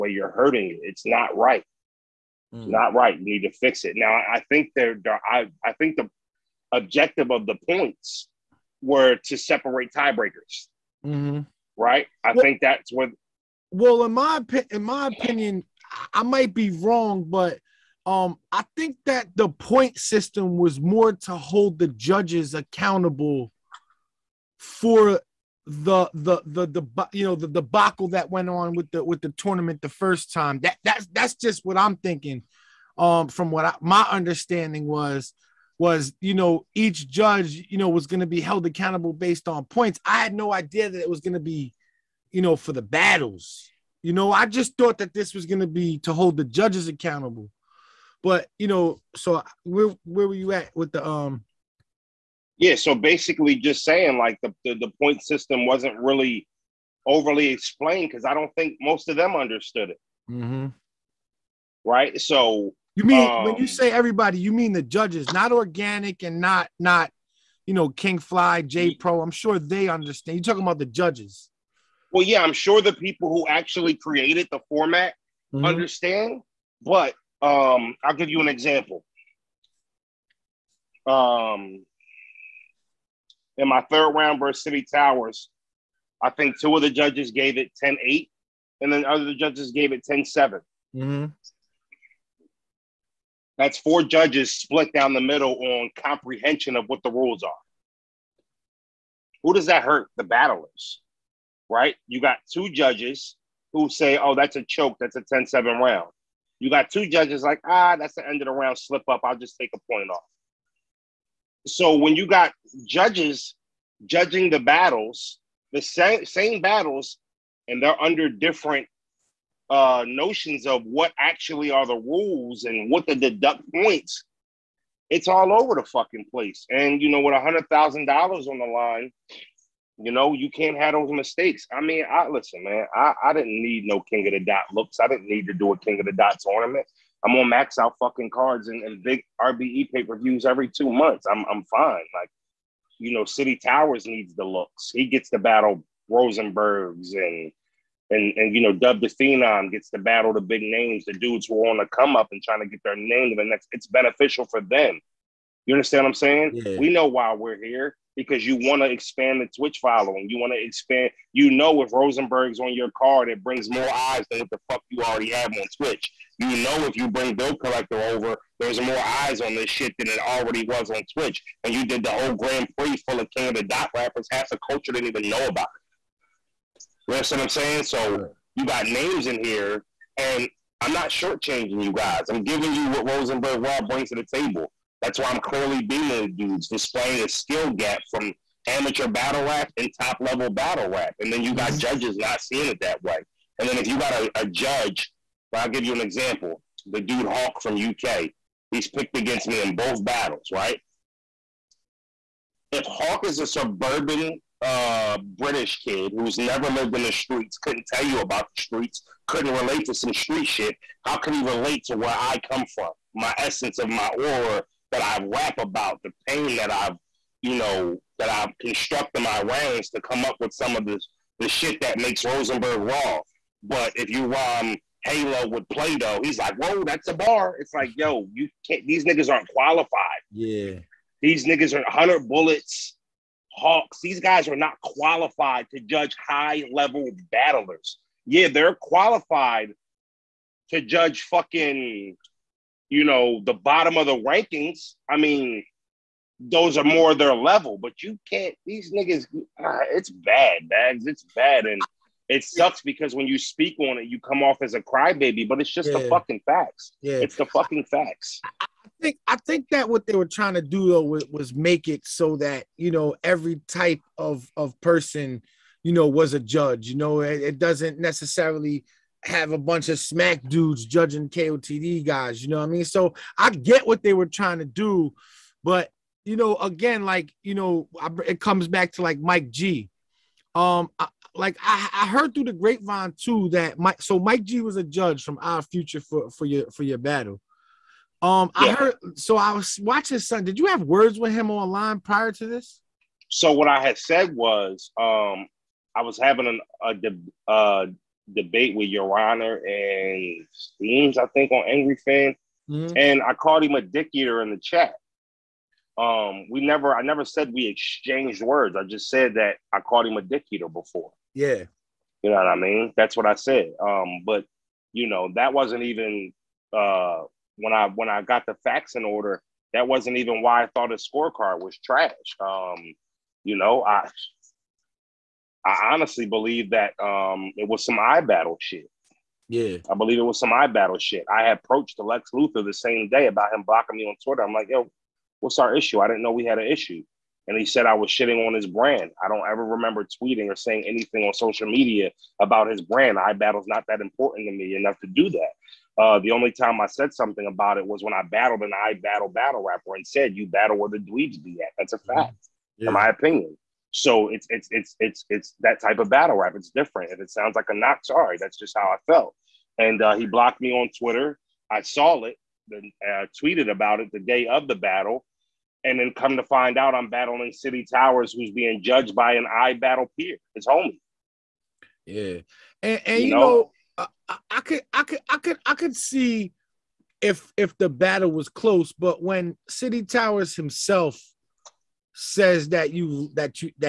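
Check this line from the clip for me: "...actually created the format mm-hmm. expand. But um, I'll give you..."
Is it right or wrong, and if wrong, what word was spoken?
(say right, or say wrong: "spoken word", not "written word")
wrong: "understand", not "expand".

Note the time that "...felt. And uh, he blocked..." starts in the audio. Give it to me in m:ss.
5:59.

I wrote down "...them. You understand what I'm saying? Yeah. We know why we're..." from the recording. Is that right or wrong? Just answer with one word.
right.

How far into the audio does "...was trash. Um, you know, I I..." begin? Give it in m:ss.
5:21.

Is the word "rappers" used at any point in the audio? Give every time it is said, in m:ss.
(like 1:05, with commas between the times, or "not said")
2:53, 5:49.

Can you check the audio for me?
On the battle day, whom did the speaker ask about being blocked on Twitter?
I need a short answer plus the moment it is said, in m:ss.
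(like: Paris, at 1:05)
Lex Luthor, at 5:31.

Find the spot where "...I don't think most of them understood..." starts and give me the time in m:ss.
0:58.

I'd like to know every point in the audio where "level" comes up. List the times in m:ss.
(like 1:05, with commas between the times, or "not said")
3:10, 3:56, 4:07.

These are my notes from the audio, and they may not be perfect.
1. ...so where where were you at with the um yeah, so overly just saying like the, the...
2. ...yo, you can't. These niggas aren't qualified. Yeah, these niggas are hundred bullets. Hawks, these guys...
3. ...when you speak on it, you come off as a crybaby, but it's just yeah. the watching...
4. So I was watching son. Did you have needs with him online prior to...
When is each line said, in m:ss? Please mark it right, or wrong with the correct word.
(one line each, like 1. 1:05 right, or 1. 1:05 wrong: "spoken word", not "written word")
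1. 0:49 wrong: "basically", not "overly"
2. 3:47 right
3. 4:13 wrong: "fucking", not "watching"
4. 4:49 wrong: "words", not "needs".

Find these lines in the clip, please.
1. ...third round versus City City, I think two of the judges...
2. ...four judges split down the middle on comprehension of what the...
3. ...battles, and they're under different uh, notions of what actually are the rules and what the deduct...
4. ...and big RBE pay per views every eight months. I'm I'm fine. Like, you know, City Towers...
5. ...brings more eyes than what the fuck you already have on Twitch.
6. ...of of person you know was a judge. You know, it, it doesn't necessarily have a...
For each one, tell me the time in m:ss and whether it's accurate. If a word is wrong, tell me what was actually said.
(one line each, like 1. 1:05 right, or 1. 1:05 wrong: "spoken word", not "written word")
1. 1:23 wrong: "Towers", not "City"
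2. 1:33 right
3. 1:56 right
4. 2:18 wrong: "two", not "eight"
5. 2:43 right
6. 4:24 right.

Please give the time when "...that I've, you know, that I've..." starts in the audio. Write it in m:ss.
3:36.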